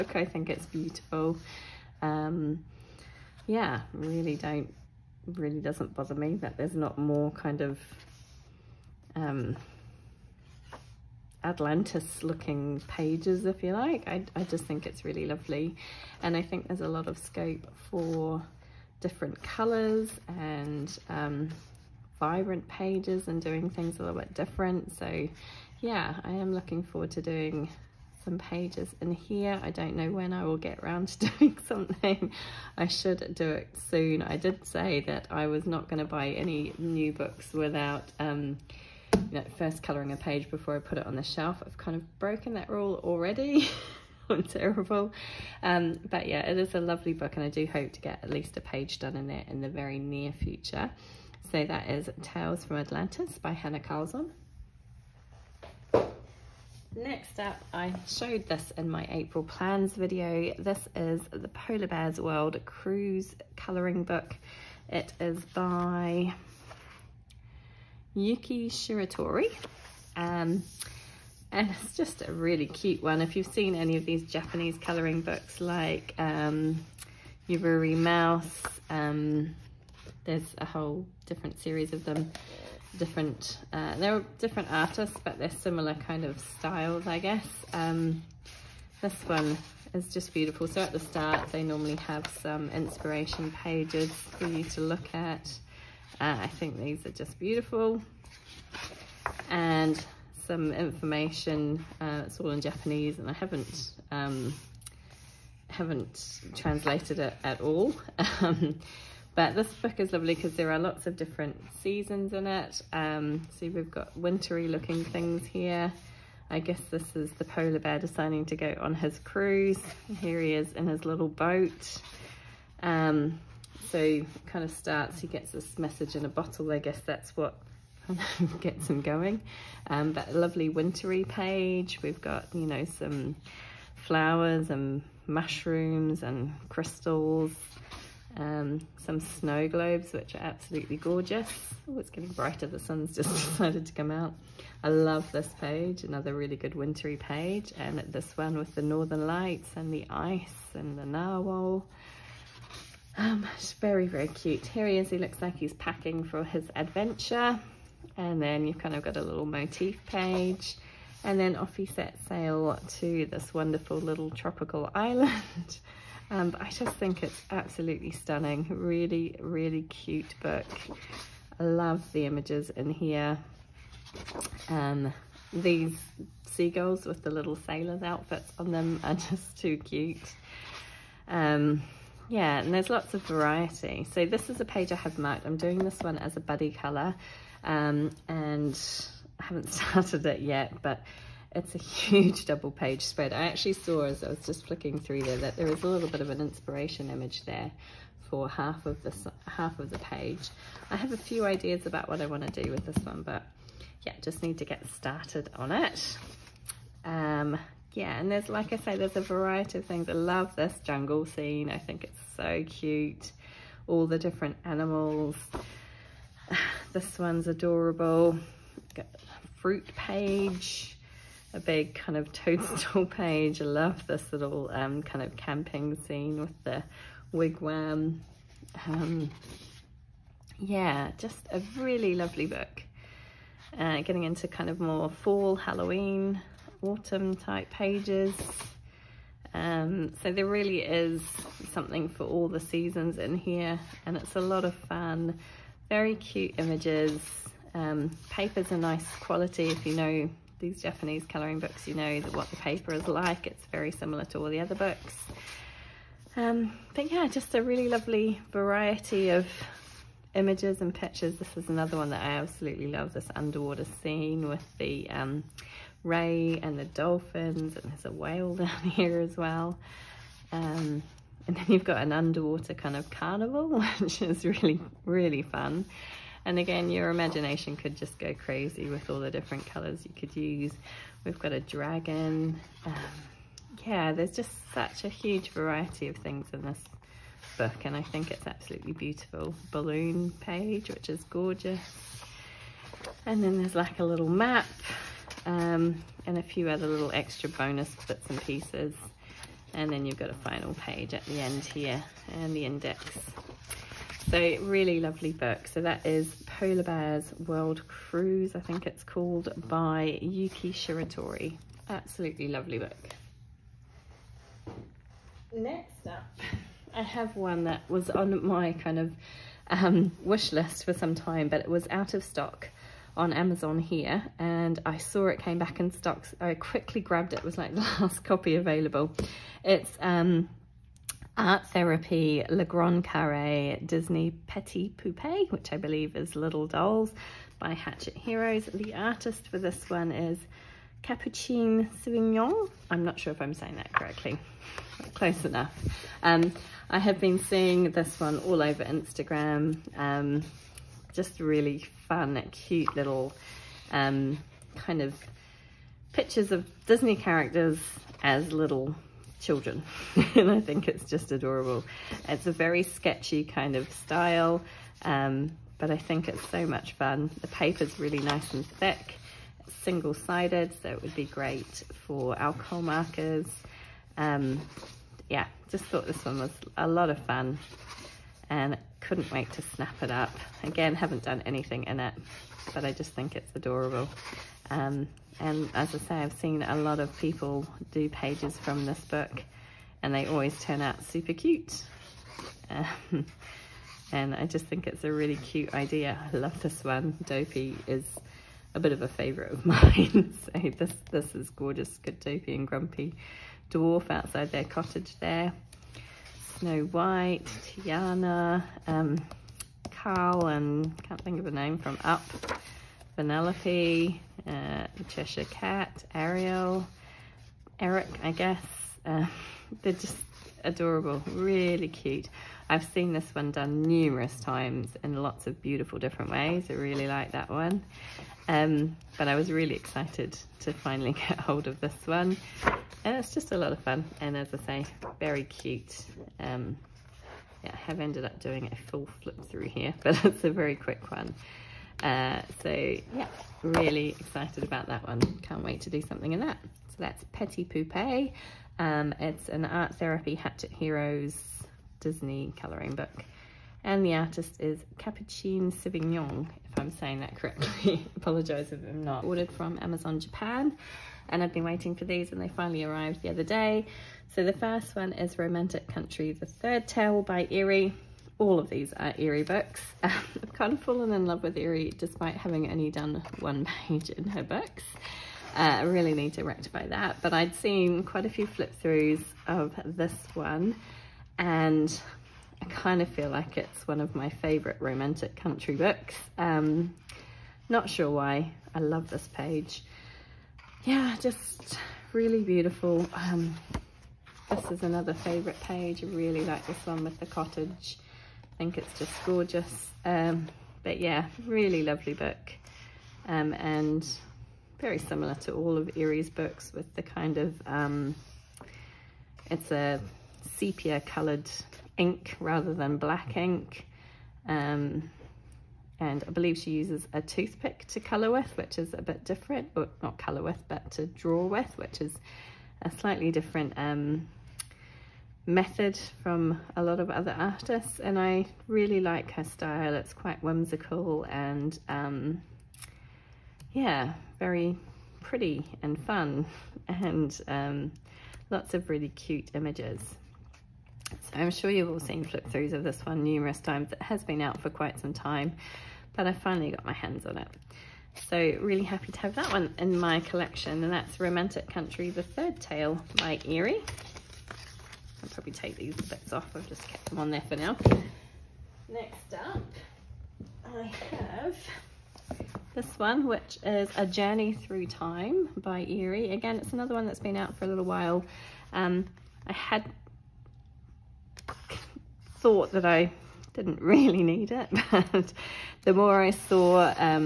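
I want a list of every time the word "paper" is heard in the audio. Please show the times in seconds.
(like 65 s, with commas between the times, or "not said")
248 s, 252 s, 367 s.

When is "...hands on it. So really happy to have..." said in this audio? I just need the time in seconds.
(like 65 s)
546 s.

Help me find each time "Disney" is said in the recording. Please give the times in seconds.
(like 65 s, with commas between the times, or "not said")
333 s, 356 s, 451 s.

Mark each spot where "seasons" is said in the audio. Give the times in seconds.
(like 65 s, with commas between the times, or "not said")
111 s, 242 s.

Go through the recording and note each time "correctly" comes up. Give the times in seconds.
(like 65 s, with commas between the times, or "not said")
343 s, 457 s.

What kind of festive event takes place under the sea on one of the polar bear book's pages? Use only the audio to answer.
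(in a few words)
Carnival.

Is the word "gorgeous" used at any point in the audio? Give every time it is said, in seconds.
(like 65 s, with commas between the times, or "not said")
140 s, 291 s, 401 s, 499 s.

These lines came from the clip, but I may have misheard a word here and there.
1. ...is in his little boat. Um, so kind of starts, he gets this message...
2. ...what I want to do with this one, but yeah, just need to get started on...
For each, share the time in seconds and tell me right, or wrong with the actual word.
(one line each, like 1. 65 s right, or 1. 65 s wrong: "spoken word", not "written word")
1. 120 s right
2. 202 s right.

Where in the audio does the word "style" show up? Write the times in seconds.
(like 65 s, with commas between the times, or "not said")
86 s, 363 s, 529 s.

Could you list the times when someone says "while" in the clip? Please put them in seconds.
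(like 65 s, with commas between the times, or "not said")
567 s.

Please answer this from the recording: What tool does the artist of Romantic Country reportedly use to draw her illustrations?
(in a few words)
A toothpick.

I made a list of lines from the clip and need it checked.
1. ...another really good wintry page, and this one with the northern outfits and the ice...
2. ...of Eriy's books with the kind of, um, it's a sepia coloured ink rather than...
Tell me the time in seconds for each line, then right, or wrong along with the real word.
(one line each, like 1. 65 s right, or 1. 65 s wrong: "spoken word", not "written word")
1. 146 s wrong: "lights", not "outfits"
2. 505 s right.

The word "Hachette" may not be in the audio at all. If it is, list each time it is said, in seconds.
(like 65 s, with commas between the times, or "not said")
337 s, 450 s.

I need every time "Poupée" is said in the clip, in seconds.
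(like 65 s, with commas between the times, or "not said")
334 s, 447 s.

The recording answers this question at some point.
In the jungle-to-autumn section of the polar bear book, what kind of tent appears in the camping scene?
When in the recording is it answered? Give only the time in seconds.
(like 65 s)
227 s.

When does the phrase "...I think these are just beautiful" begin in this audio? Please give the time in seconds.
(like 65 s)
96 s.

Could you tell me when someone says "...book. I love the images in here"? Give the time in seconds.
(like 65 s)
170 s.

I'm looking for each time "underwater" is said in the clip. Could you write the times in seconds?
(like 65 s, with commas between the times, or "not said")
263 s, 272 s.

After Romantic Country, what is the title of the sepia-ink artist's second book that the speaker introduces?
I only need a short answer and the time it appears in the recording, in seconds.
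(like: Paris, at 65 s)
A Journey Through Time, at 563 s.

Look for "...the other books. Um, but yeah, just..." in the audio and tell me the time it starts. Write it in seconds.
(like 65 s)
254 s.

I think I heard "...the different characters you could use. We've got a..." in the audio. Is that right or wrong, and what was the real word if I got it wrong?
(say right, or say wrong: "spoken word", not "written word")
wrong: "colors", not "characters".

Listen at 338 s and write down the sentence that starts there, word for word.
The artist for this one is Capuchin Sauvignon.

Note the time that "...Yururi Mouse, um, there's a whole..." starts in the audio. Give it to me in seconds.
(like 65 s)
77 s.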